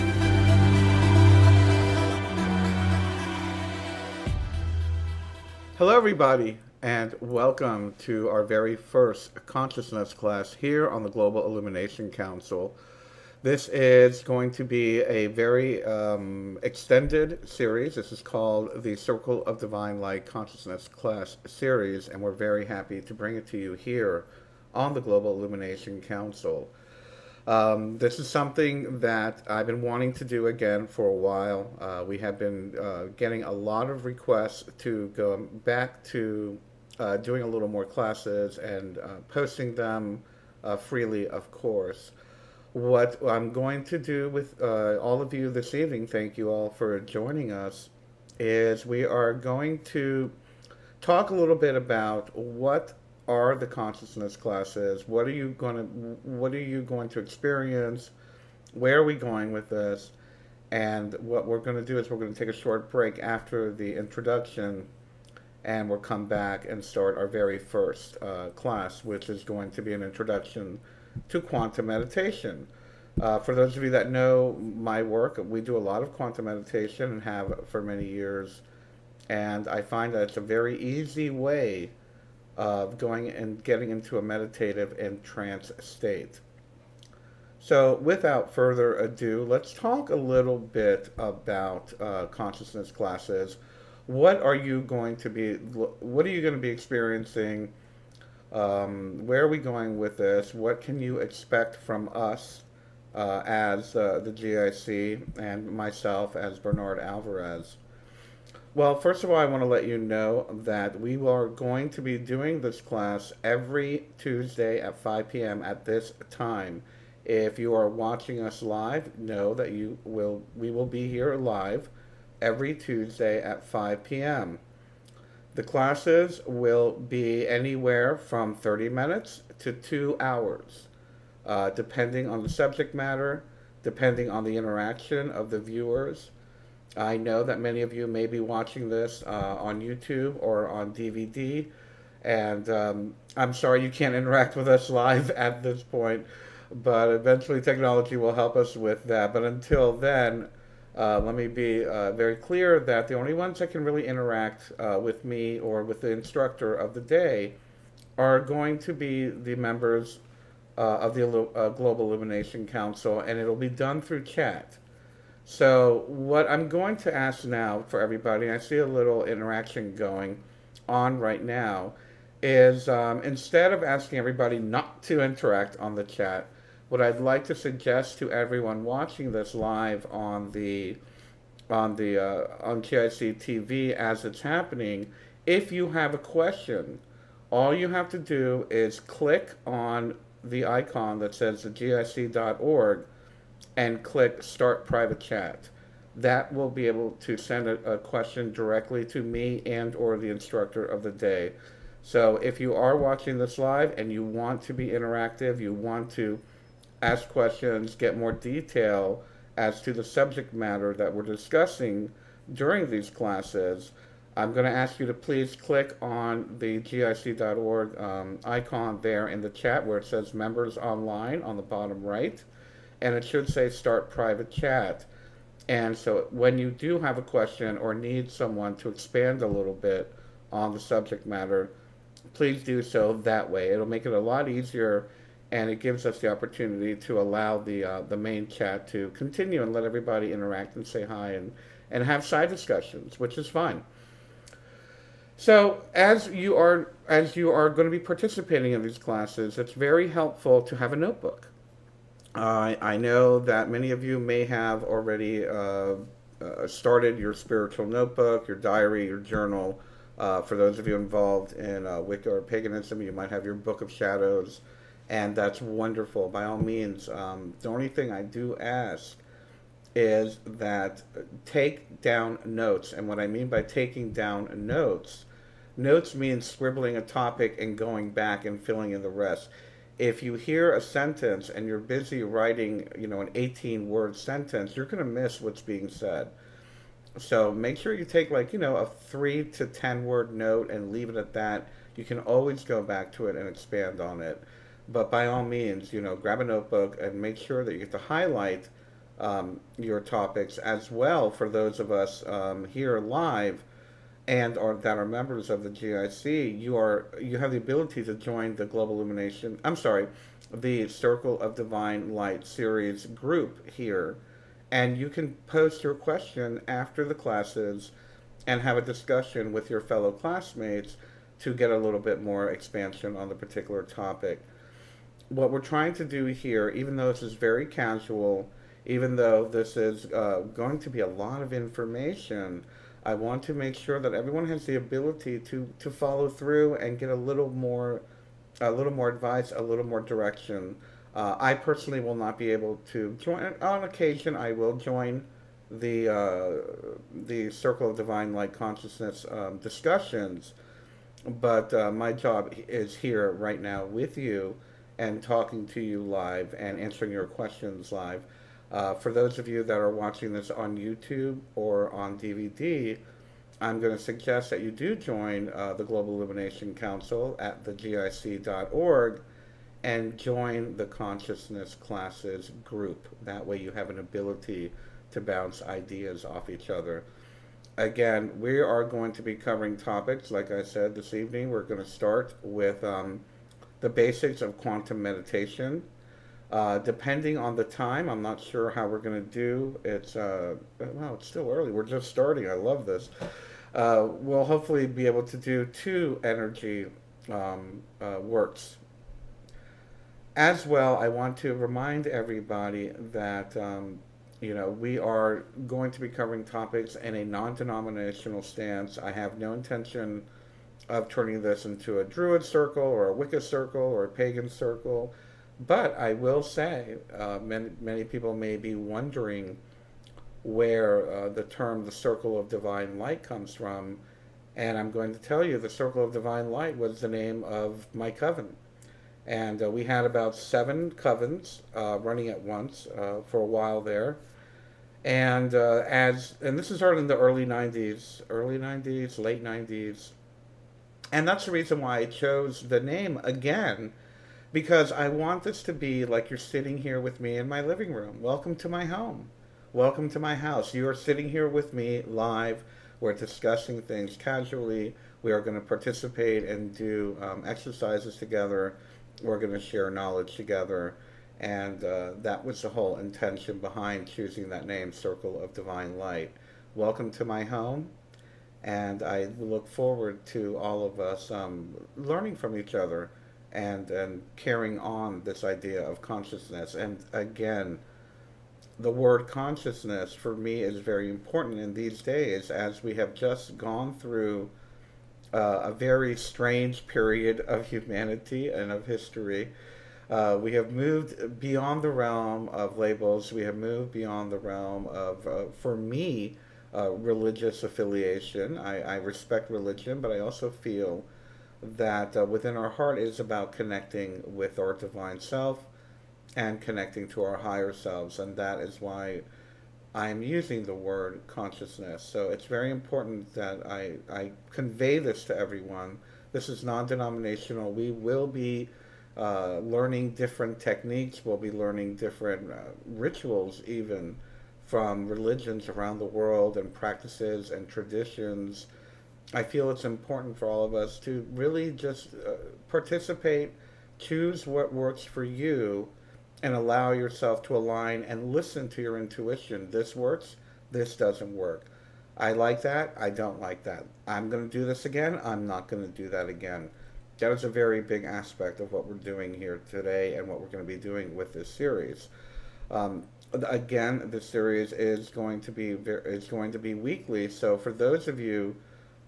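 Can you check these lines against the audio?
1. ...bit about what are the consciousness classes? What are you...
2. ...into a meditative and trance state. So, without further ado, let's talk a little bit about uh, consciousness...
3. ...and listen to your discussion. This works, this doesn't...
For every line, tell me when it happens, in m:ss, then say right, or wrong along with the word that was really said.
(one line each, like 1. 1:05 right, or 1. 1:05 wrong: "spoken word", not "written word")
1. 0:51 right
2. 1:23 right
3. 8:58 wrong: "intuition", not "discussion".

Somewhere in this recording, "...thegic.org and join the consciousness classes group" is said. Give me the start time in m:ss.
6:07.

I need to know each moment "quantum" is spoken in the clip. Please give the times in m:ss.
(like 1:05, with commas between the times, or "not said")
1:11, 1:16, 6:24.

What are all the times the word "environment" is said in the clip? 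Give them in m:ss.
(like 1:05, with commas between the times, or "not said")
not said.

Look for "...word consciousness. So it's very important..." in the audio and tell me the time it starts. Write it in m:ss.
8:30.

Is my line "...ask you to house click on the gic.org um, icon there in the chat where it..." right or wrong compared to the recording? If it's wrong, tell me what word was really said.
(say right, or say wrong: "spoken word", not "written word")
wrong: "please", not "house".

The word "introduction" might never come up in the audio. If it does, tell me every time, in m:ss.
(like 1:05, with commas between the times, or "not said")
1:03, 1:10.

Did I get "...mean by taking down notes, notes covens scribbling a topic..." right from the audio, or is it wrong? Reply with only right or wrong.
wrong.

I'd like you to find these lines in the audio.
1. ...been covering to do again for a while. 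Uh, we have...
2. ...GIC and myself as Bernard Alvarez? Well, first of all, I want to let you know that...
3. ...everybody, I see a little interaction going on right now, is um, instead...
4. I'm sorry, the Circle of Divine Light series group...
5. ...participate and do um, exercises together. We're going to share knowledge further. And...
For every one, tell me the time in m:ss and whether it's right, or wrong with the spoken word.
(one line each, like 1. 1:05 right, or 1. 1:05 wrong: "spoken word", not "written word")
1. 0:29 wrong: "wanting", not "covering"
2. 1:44 right
3. 2:48 right
4. 5:09 right
5. 7:35 wrong: "together", not "further".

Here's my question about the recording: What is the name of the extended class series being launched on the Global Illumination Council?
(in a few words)
Circle of Divine Light Consciousness Class Series.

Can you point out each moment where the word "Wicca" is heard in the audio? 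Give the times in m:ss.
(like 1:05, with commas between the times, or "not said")
4:22, 6:53.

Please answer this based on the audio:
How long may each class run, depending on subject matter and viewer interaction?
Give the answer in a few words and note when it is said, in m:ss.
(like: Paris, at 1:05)
30 minutes to two hours, at 2:08.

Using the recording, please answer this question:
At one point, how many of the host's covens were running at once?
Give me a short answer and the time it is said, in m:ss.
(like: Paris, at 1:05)
7, at 7:10.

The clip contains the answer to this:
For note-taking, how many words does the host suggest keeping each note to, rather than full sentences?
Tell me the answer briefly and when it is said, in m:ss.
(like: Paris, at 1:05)
3 to 10, at 4:48.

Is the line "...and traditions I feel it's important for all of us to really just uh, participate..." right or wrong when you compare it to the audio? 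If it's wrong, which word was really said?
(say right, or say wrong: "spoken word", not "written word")
right.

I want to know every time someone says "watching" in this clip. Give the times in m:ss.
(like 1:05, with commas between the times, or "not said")
1:57, 2:18, 2:58, 3:22, 5:59.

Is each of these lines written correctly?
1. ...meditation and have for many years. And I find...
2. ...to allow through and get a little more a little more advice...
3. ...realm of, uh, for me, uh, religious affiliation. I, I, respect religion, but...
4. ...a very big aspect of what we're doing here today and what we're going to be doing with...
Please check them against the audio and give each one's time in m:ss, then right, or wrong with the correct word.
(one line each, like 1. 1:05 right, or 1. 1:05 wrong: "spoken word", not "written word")
1. 1:16 right
2. 5:35 wrong: "follow", not "allow"
3. 8:14 right
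4. 9:07 right.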